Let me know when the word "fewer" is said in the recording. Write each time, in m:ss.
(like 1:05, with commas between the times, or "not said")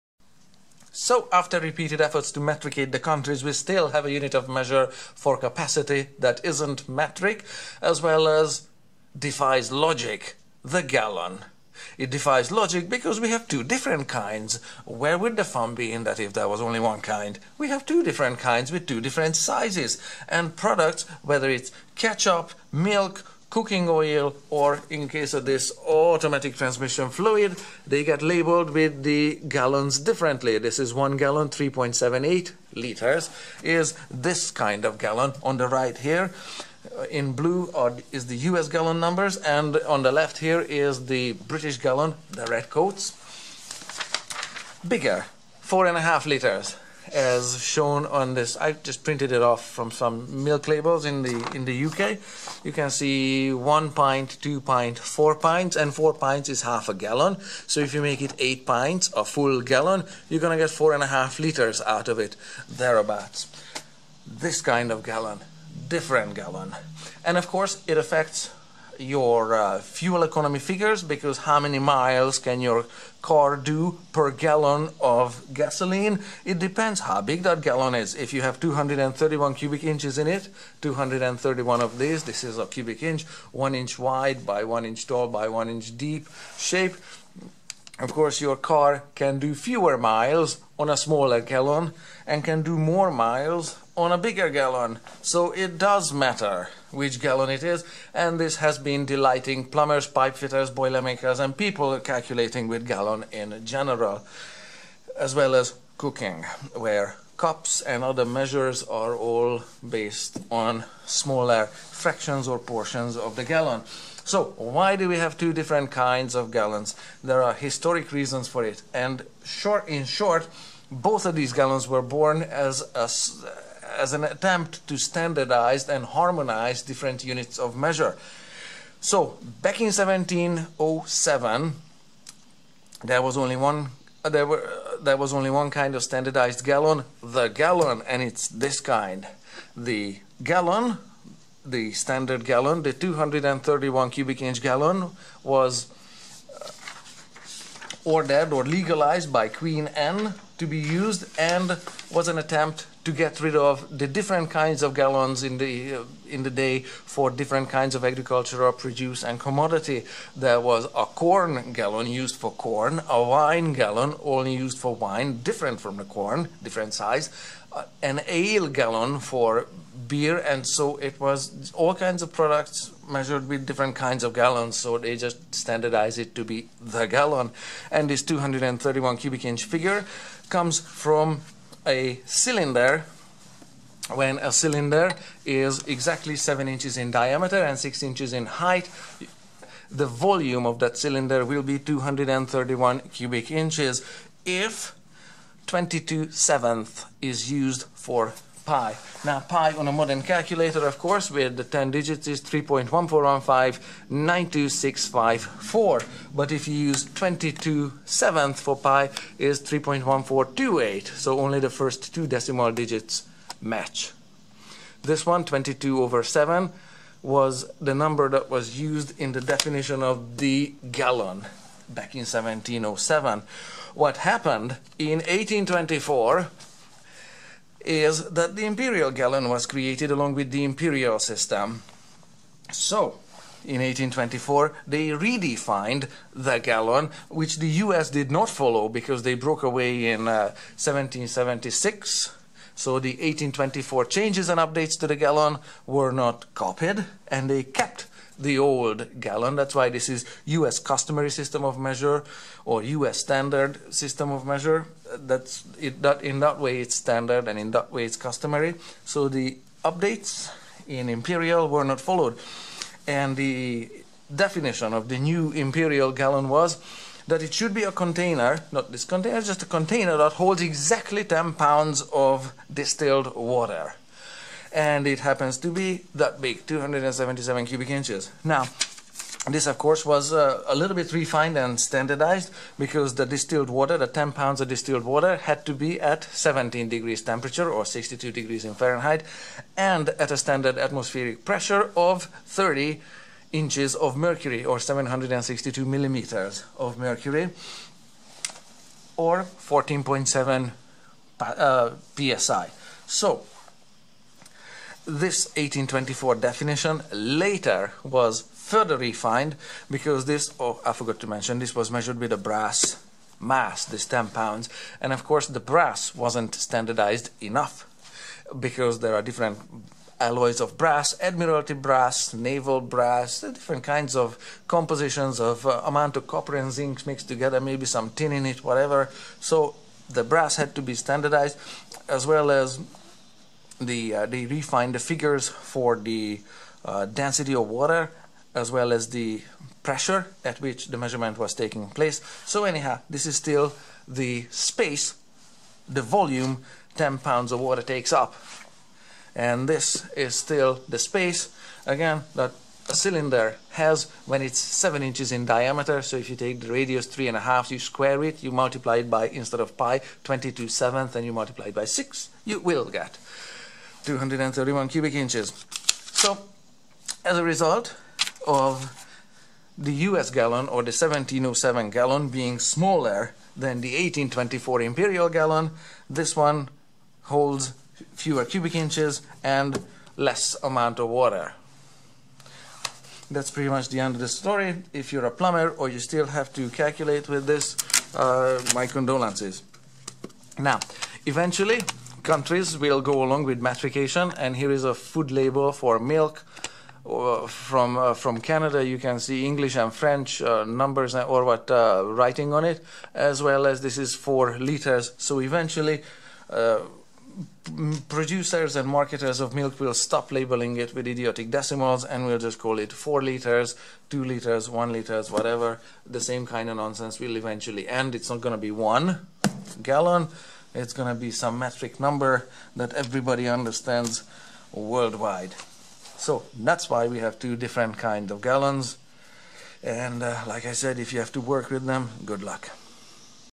1:29, 6:18.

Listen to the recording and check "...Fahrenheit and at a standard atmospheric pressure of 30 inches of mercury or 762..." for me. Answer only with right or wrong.
right.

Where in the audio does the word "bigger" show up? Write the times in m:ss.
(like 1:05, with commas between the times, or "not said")
0:44, 1:34.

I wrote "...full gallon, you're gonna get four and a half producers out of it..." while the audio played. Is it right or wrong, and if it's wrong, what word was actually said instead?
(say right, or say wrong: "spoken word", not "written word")
wrong: "liters", not "producers".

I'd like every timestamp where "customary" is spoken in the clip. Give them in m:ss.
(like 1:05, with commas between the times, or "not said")
4:10, 4:18.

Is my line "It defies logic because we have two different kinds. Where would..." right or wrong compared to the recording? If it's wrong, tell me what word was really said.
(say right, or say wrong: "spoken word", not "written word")
right.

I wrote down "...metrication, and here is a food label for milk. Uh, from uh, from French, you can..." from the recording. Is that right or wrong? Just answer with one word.
wrong.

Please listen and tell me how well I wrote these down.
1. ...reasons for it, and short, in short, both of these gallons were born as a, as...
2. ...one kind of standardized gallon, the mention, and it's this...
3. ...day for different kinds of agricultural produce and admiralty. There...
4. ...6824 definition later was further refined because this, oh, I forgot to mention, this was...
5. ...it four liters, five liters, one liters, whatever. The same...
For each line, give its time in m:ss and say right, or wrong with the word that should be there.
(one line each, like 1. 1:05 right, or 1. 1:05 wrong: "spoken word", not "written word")
1. 1:58 right
2. 2:15 wrong: "gallon", not "mention"
3. 2:36 wrong: "commodity", not "admiralty"
4. 5:05 wrong: "1824", not "6824"
5. 6:52 wrong: "two", not "five".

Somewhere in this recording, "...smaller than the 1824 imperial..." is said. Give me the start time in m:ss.
6:12.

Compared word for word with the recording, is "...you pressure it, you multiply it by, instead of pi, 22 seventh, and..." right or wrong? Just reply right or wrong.
wrong.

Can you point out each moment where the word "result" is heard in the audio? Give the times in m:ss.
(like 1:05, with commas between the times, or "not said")
6:07.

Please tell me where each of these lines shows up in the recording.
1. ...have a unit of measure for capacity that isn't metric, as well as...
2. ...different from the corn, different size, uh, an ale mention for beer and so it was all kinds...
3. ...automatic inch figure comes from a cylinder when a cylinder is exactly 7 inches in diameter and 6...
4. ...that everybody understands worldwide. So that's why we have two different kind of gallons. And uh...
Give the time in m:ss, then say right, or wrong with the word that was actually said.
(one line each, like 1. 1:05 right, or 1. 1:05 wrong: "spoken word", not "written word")
1. 0:03 right
2. 2:45 wrong: "gallon", not "mention"
3. 2:59 wrong: "cubic", not "automatic"
4. 7:02 right.